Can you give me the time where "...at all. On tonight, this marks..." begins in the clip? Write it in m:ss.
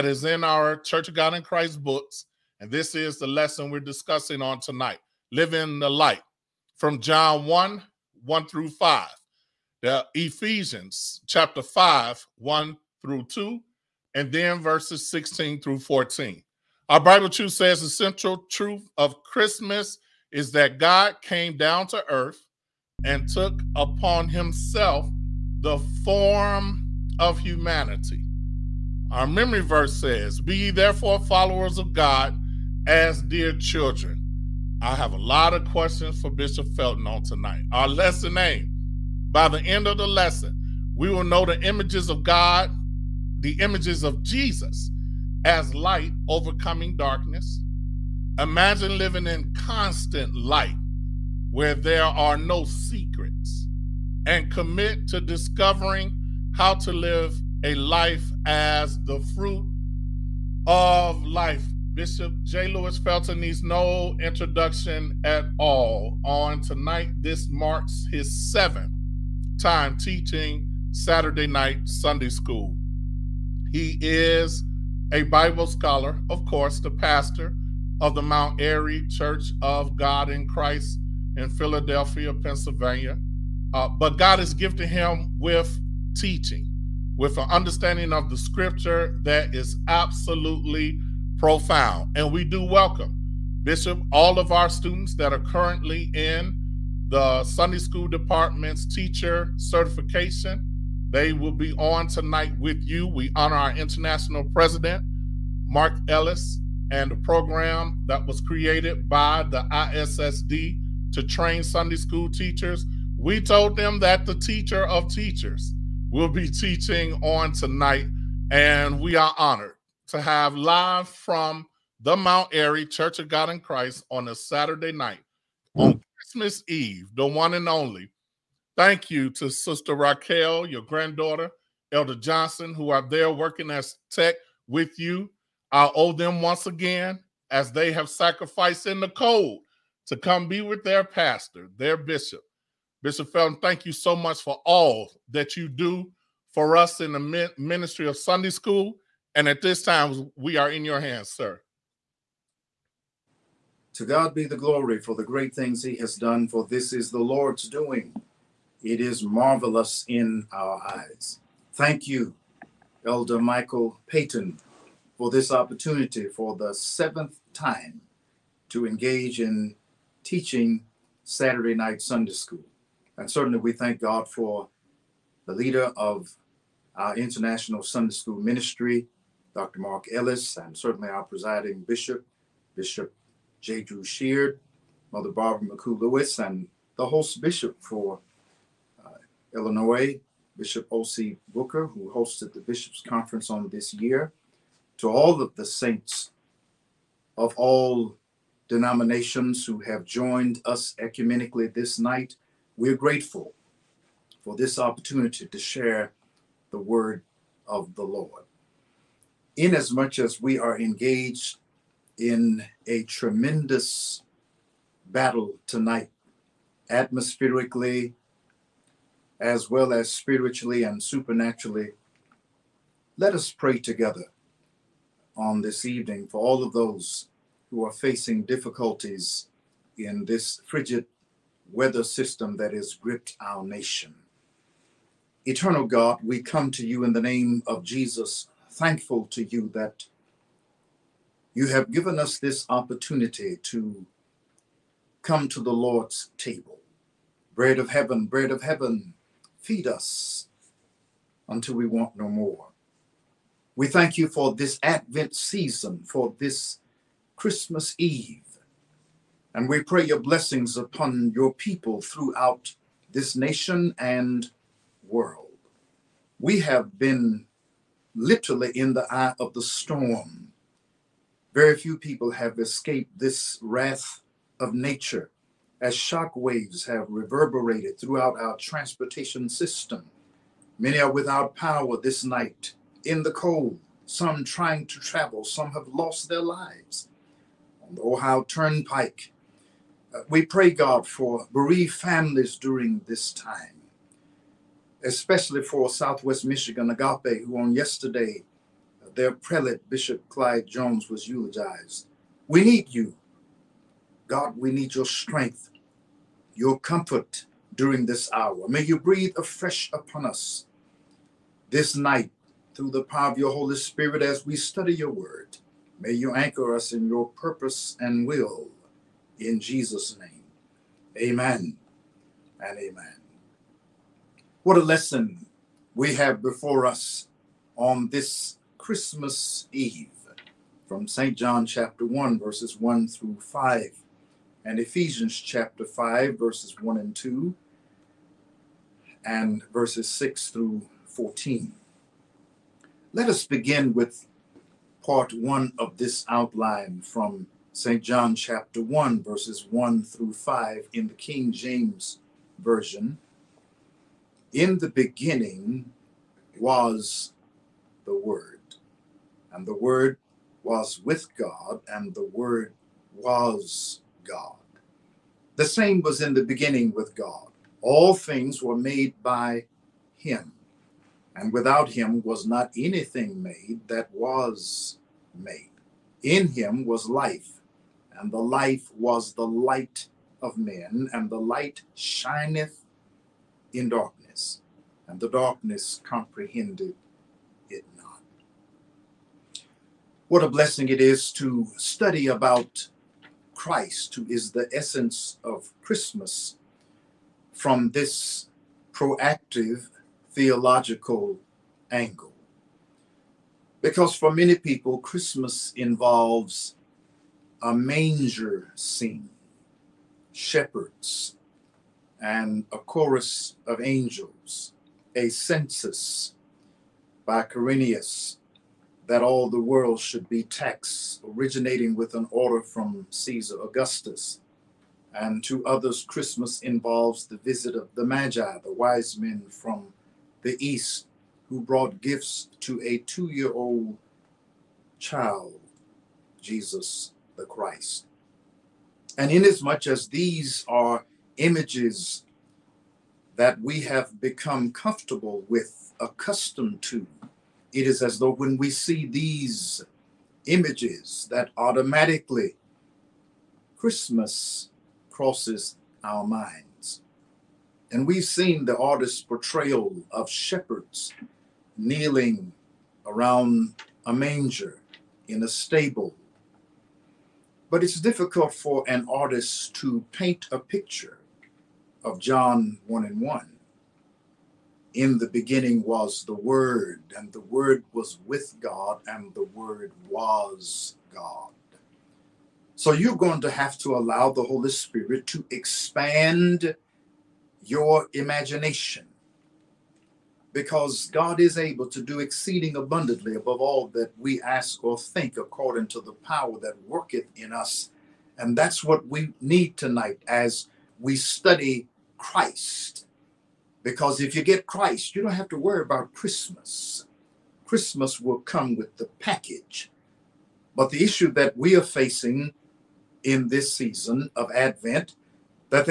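1:05.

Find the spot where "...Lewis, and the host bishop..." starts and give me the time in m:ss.
3:06.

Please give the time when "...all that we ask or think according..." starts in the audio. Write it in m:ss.
8:13.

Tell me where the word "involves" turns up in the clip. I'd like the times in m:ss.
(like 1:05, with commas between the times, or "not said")
6:45, 7:06.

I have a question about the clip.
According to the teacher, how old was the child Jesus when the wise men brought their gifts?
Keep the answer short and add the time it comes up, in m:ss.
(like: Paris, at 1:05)
2 years old, at 7:12.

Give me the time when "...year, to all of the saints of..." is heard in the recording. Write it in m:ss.
3:13.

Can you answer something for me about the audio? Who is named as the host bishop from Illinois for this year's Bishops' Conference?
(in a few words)
O.C. Booker.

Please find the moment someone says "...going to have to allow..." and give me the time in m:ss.
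8:03.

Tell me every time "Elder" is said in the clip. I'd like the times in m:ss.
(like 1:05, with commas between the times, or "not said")
2:11, 2:43.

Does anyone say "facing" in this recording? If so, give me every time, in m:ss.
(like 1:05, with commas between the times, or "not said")
3:47, 8:31.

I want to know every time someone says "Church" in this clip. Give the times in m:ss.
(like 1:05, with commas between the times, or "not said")
0:00, 1:19, 2:02.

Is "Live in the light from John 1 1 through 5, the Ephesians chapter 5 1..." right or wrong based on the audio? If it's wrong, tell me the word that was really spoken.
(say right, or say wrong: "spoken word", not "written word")
right.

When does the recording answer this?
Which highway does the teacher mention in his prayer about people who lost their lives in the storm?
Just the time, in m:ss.
4:48.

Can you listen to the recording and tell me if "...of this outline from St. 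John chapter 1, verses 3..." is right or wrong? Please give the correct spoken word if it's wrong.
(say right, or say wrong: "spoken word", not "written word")
wrong: "1", not "3".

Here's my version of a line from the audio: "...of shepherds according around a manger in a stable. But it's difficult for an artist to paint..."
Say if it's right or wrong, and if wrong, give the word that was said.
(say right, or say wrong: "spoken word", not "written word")
wrong: "kneeling", not "according".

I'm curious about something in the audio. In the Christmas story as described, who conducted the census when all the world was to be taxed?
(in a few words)
Quirinius.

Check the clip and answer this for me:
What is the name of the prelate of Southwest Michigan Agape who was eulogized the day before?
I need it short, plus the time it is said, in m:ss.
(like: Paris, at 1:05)
Clyde Jones, at 4:59.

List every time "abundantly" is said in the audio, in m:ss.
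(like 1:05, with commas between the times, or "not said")
8:12.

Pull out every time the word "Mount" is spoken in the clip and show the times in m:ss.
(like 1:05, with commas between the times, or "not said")
1:18, 2:02.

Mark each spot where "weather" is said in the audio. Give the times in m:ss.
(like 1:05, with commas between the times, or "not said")
3:51.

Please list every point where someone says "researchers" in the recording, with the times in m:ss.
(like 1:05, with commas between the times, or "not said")
not said.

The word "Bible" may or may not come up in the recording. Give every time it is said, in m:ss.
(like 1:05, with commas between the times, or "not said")
0:17, 1:15.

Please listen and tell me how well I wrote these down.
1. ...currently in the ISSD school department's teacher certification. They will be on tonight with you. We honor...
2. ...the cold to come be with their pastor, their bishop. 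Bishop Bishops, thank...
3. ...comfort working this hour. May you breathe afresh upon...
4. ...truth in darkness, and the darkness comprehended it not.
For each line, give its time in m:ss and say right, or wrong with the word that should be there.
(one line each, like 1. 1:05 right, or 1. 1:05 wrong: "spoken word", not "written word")
1. 1:35 wrong: "Sunday", not "ISSD"
2. 2:18 wrong: "Felton", not "Bishops"
3. 5:06 wrong: "during", not "working"
4. 6:21 wrong: "shineth", not "truth".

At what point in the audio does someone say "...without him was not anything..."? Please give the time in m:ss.
6:11.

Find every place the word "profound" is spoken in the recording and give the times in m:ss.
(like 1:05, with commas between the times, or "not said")
1:31.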